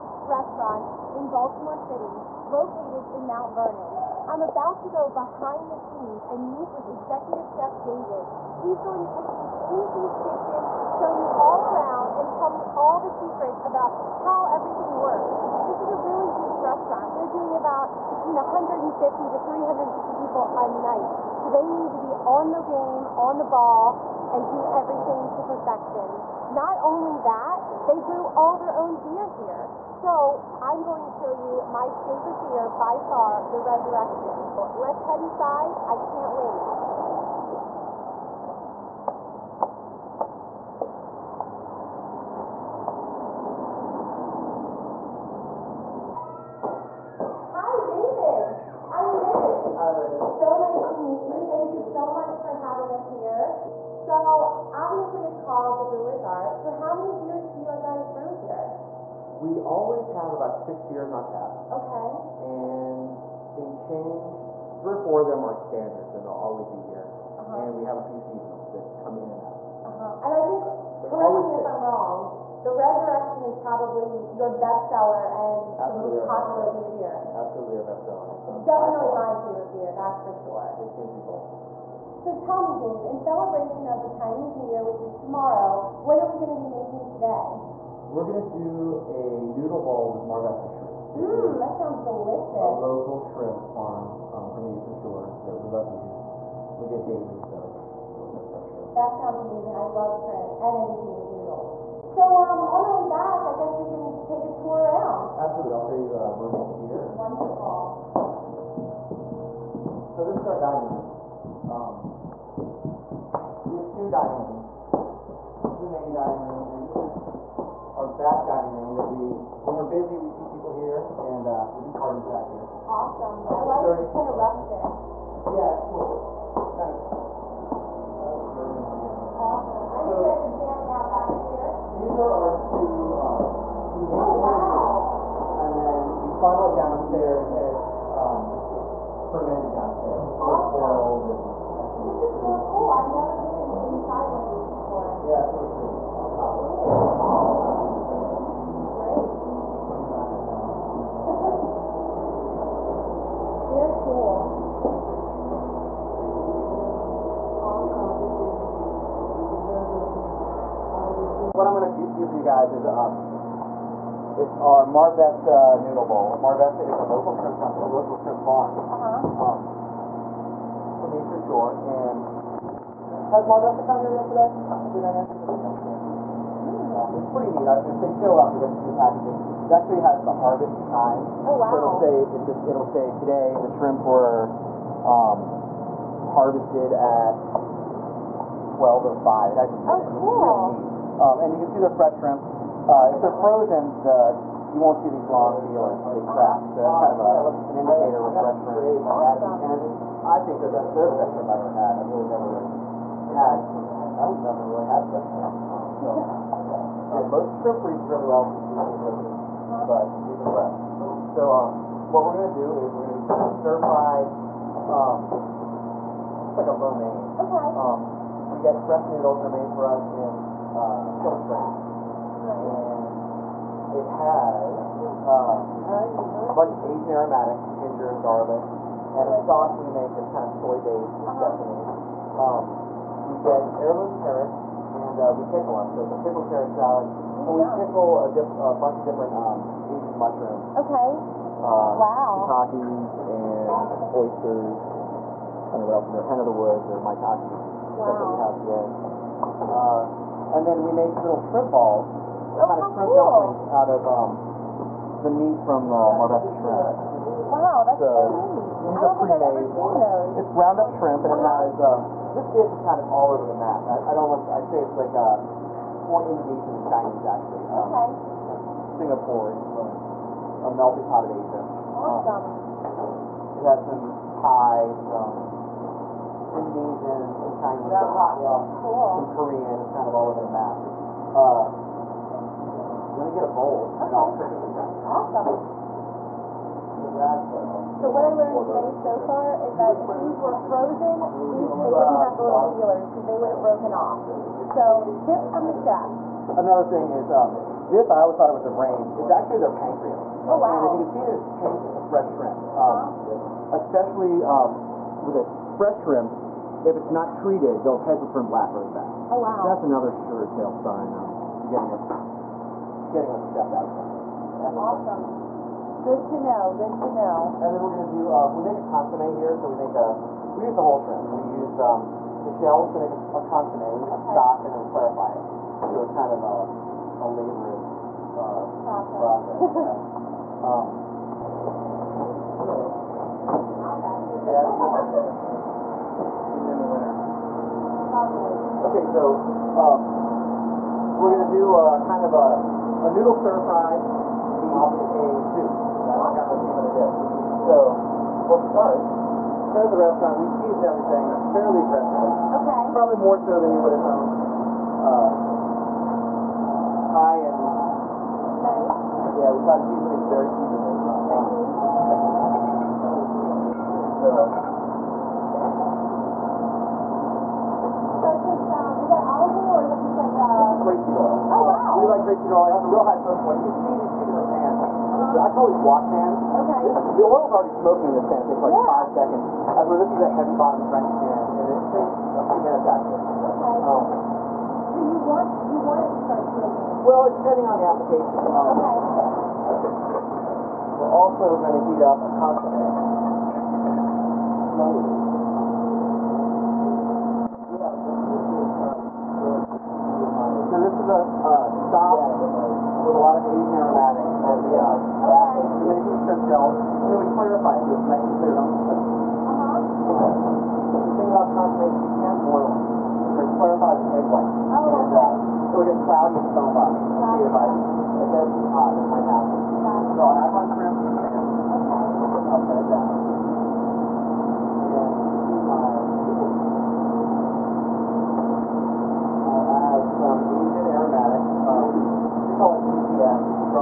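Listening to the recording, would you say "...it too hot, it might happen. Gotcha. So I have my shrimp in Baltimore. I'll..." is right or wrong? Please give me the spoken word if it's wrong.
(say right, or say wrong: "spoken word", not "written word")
wrong: "Okay", not "Baltimore".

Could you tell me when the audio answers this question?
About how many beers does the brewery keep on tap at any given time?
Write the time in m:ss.
1:00.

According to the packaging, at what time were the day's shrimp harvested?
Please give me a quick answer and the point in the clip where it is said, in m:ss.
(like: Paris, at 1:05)
12:05, at 3:08.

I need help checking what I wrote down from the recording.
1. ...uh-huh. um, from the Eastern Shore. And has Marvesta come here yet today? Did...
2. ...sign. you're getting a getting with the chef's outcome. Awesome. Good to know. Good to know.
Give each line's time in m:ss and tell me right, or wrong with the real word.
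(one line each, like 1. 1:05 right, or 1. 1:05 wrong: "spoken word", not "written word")
1. 2:48 right
2. 5:10 right.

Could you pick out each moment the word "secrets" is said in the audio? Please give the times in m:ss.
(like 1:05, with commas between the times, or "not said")
0:13.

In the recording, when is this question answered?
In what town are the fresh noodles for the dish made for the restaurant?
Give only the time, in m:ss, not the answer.
3:41.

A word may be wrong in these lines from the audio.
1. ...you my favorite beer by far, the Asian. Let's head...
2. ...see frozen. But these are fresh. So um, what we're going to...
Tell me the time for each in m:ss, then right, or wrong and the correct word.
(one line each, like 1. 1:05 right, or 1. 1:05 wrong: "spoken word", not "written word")
1. 0:31 wrong: "Resurrection", not "Asian"
2. 3:28 right.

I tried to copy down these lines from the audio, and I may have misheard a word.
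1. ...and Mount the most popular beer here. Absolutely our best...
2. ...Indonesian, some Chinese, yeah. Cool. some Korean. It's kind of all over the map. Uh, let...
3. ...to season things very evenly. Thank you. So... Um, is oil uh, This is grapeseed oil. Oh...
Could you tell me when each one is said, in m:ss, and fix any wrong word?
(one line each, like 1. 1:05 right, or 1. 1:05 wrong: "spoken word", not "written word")
1. 1:15 wrong: "Absolutely", not "Mount"
2. 4:36 right
3. 5:59 right.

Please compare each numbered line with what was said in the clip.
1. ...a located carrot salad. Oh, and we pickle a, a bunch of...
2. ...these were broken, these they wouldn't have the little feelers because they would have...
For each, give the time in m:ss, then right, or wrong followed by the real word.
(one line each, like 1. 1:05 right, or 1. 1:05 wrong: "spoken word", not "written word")
1. 3:56 wrong: "pickled", not "located"
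2. 4:50 wrong: "frozen", not "broken".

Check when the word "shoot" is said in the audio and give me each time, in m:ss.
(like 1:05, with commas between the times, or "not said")
not said.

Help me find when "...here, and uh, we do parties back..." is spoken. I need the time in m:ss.
2:00.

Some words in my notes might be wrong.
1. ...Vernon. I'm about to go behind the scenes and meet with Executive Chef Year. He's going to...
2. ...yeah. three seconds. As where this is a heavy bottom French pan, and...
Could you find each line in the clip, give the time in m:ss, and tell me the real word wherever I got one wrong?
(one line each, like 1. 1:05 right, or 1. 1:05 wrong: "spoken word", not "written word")
1. 0:03 wrong: "David", not "Year"
2. 6:18 wrong: "five", not "three".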